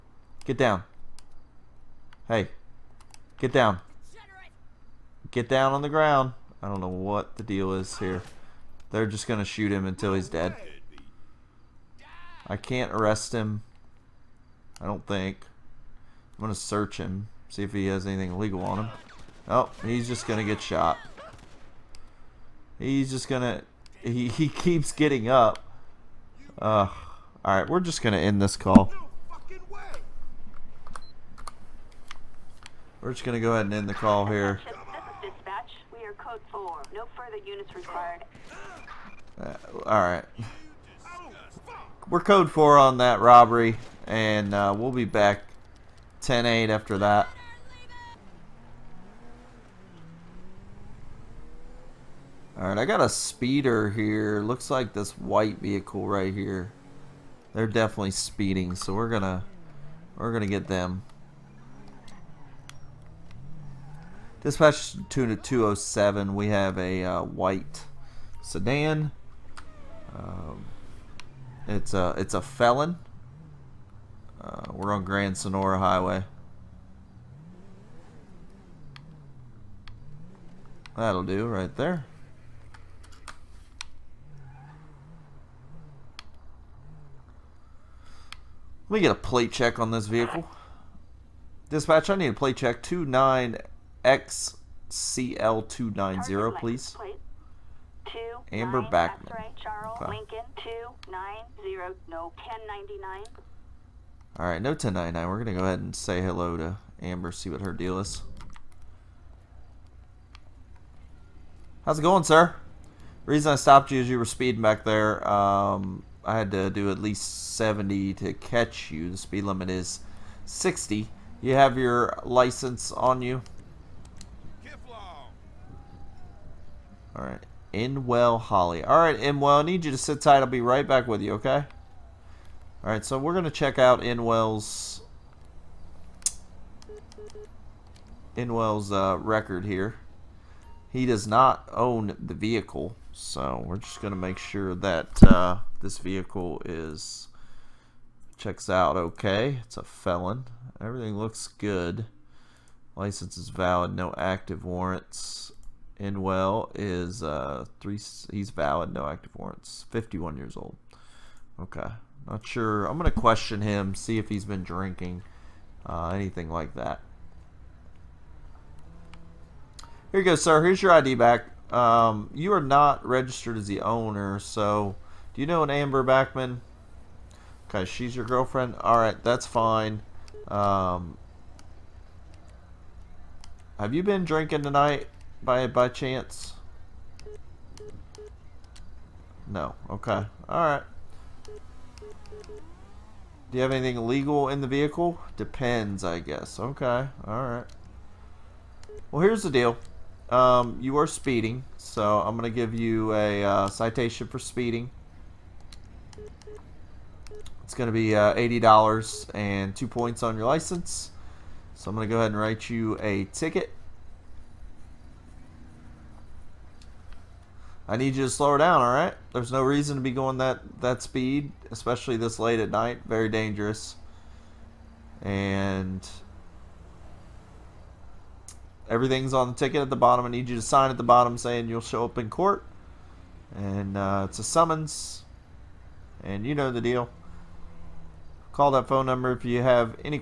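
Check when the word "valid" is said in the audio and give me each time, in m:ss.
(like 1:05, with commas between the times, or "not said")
2:33, 2:38.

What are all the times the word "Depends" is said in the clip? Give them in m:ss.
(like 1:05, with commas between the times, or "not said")
3:15.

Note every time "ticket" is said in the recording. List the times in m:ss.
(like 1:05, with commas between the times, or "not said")
3:33, 3:49.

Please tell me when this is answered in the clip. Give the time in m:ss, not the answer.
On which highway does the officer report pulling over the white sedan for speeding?
1:15.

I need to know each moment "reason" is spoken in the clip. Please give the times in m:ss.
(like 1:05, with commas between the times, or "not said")
1:53, 3:39.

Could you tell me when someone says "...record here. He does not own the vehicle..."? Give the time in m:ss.
2:19.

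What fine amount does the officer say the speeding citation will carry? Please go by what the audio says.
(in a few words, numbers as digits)
$80.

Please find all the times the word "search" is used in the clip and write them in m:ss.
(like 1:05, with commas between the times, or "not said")
0:16.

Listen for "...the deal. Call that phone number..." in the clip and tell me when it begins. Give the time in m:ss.
3:56.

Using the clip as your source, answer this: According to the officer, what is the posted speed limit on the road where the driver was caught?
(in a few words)
60.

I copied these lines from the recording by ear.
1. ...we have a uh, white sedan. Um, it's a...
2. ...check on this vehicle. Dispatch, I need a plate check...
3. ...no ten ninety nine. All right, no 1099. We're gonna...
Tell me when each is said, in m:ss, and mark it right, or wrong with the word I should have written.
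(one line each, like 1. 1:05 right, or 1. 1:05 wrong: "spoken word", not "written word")
1. 1:06 right
2. 1:29 right
3. 1:42 right.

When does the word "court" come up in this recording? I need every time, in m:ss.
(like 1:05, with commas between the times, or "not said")
3:52.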